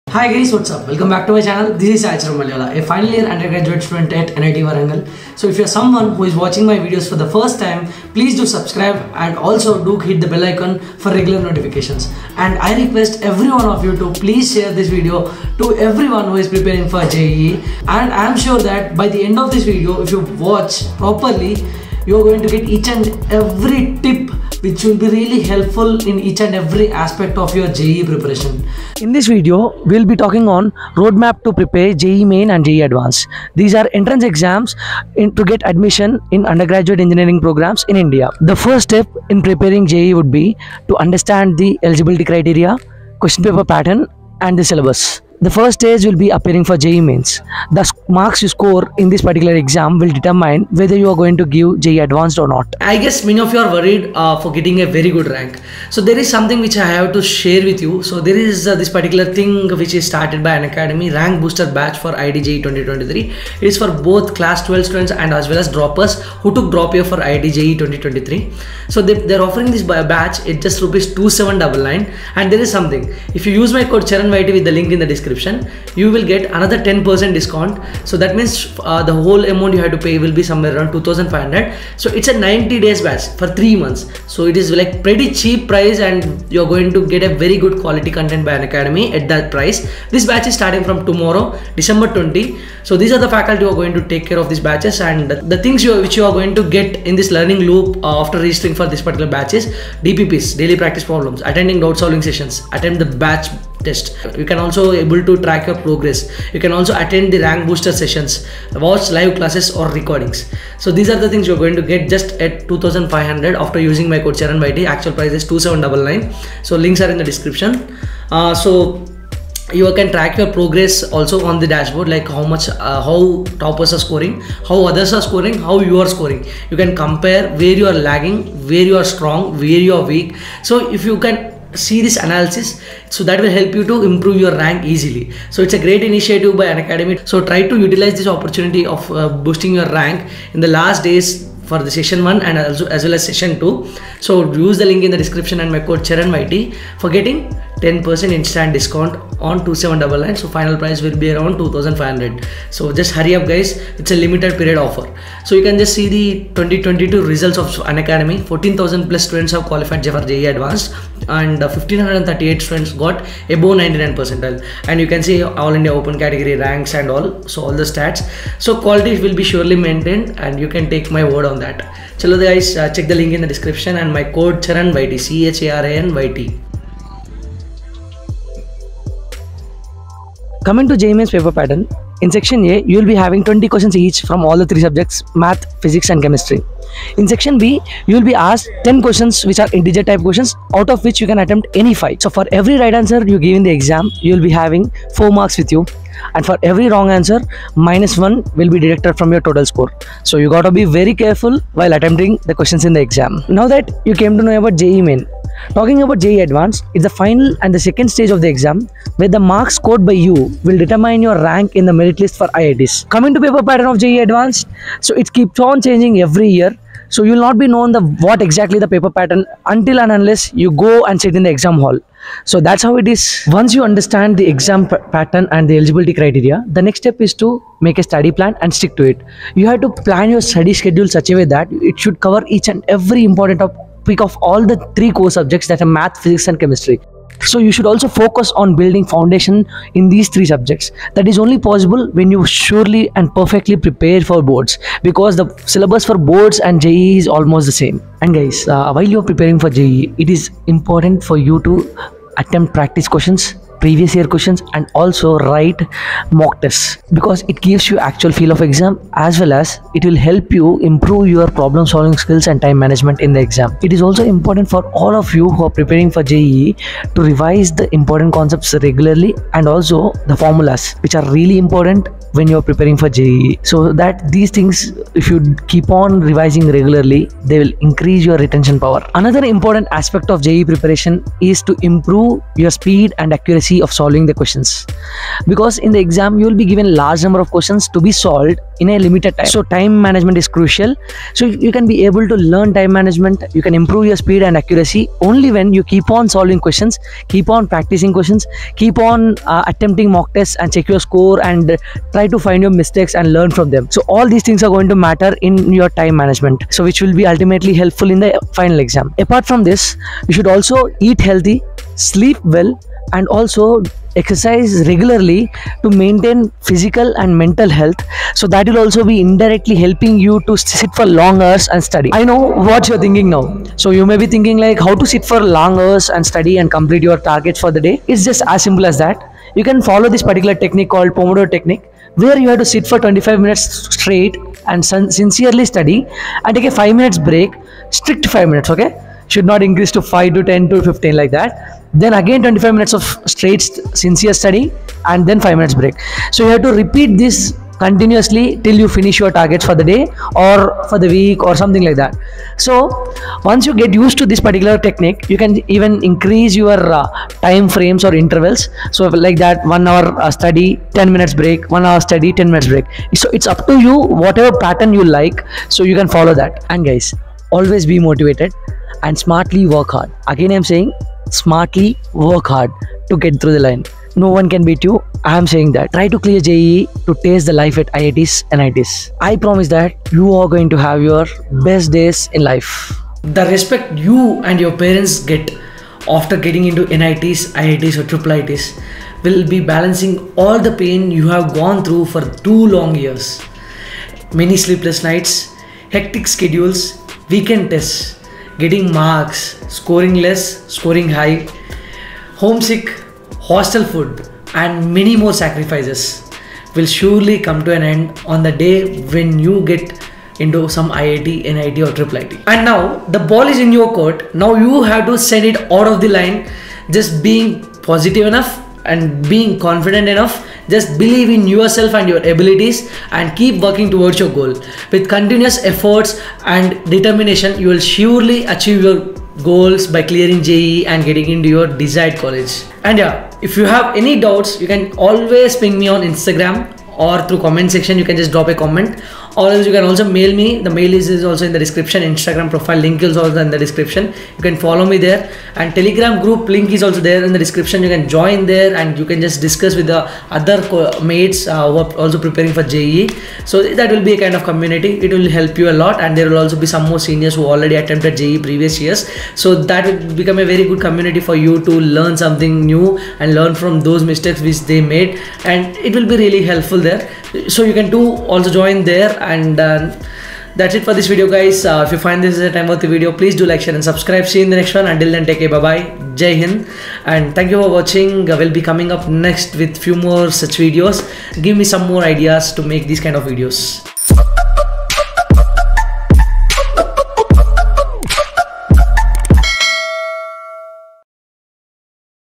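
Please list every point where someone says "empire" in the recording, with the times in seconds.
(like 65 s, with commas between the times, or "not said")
not said.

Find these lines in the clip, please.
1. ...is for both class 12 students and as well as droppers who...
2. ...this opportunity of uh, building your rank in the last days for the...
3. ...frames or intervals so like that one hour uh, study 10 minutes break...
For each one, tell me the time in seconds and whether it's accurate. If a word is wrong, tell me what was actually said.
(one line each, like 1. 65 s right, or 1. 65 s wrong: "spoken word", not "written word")
1. 63 s right
2. 138 s wrong: "boosting", not "building"
3. 357 s right.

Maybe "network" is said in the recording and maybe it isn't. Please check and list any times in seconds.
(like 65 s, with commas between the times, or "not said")
not said.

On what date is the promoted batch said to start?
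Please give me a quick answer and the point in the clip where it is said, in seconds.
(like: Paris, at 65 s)
December 20, at 91 s.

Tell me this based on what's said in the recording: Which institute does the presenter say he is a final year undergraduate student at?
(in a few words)
NIT Warangal.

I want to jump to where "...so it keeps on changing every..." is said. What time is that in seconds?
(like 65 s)
215 s.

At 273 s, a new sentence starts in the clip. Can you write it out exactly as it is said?
So that these things, if you keep on revising regularly, they will increase your retention power.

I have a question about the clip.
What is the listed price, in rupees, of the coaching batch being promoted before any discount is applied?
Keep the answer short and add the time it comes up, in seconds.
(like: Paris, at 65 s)
2799, at 70 s.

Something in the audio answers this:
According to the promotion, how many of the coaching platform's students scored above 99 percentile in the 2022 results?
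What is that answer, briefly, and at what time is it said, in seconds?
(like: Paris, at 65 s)
1538, at 161 s.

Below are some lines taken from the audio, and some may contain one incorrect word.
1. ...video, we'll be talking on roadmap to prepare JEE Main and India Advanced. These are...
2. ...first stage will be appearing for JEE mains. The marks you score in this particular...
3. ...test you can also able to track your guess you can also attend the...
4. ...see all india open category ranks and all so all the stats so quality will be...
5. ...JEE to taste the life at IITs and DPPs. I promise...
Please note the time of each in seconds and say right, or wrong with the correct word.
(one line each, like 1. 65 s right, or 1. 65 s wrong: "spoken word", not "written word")
1. 29 s wrong: "JEE", not "India"
2. 45 s right
3. 103 s wrong: "progress", not "guess"
4. 165 s right
5. 376 s wrong: "IITs", not "DPPs".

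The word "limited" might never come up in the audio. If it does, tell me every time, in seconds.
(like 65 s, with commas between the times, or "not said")
154 s, 289 s.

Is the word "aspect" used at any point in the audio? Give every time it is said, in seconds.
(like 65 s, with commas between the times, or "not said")
26 s, 279 s.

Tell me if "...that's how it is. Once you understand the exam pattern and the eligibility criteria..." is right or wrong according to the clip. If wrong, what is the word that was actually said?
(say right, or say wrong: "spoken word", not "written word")
right.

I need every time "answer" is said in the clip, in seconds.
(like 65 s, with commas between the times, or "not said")
192 s, 197 s.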